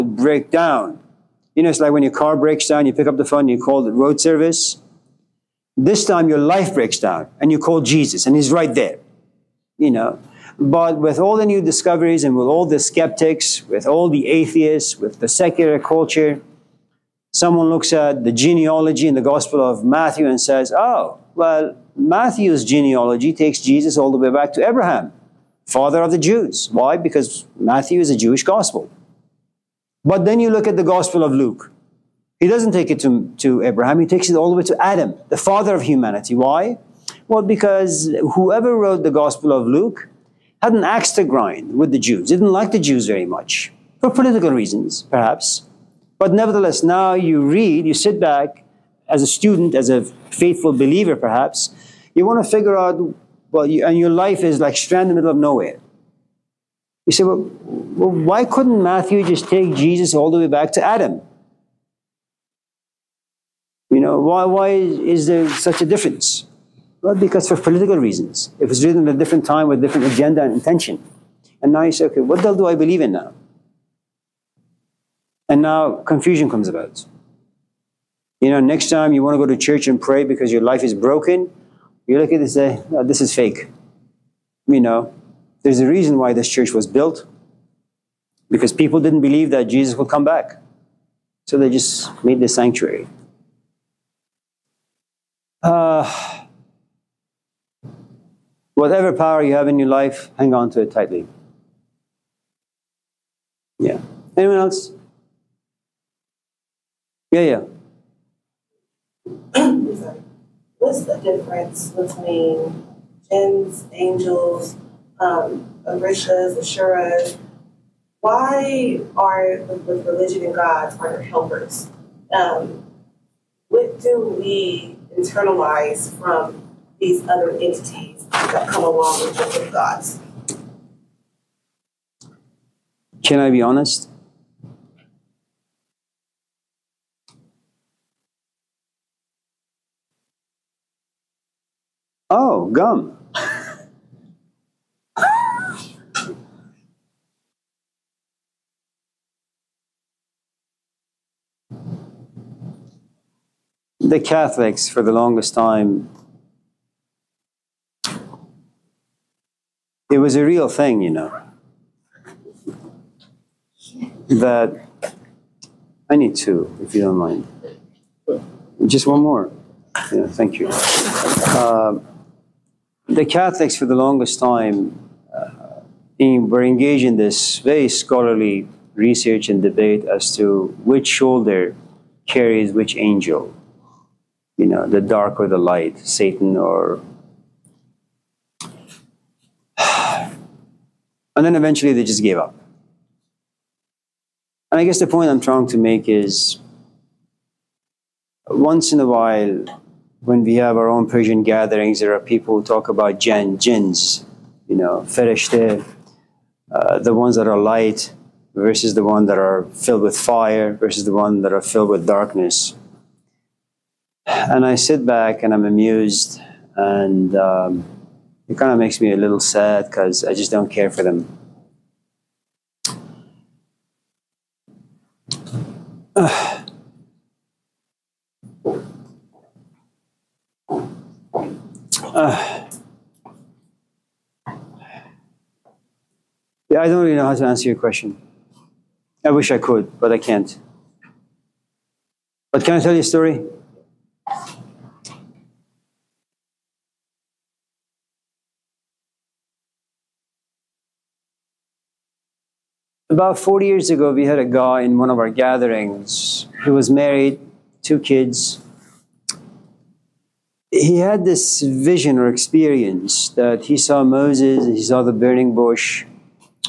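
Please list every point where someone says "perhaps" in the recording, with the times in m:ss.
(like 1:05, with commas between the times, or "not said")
0:45, 0:51.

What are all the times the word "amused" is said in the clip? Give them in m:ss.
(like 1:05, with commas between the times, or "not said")
3:35.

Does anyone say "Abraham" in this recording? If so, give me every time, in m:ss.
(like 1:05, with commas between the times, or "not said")
0:24, 0:33.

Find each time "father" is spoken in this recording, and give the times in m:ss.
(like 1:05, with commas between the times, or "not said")
0:25, 0:35.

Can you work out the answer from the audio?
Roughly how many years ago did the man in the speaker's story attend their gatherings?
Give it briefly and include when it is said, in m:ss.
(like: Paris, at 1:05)
40, at 4:13.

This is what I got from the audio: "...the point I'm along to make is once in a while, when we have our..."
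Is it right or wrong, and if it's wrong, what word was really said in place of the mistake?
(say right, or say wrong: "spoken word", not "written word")
wrong: "trying", not "along".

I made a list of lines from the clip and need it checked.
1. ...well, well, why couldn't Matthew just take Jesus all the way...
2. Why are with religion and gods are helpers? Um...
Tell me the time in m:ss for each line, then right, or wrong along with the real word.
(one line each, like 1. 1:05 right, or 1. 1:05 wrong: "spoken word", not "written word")
1. 0:57 right
2. 1:58 right.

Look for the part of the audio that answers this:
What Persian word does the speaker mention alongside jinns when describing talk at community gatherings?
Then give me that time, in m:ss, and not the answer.
3:25.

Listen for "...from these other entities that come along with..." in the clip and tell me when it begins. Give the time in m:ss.
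2:06.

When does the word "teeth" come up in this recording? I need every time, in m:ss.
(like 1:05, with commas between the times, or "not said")
not said.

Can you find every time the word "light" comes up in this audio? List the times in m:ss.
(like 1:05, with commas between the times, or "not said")
3:05, 3:27.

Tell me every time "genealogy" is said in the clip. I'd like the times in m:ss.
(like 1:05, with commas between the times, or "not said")
0:18, 0:22.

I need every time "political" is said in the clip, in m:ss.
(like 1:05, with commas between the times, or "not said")
0:44, 1:07.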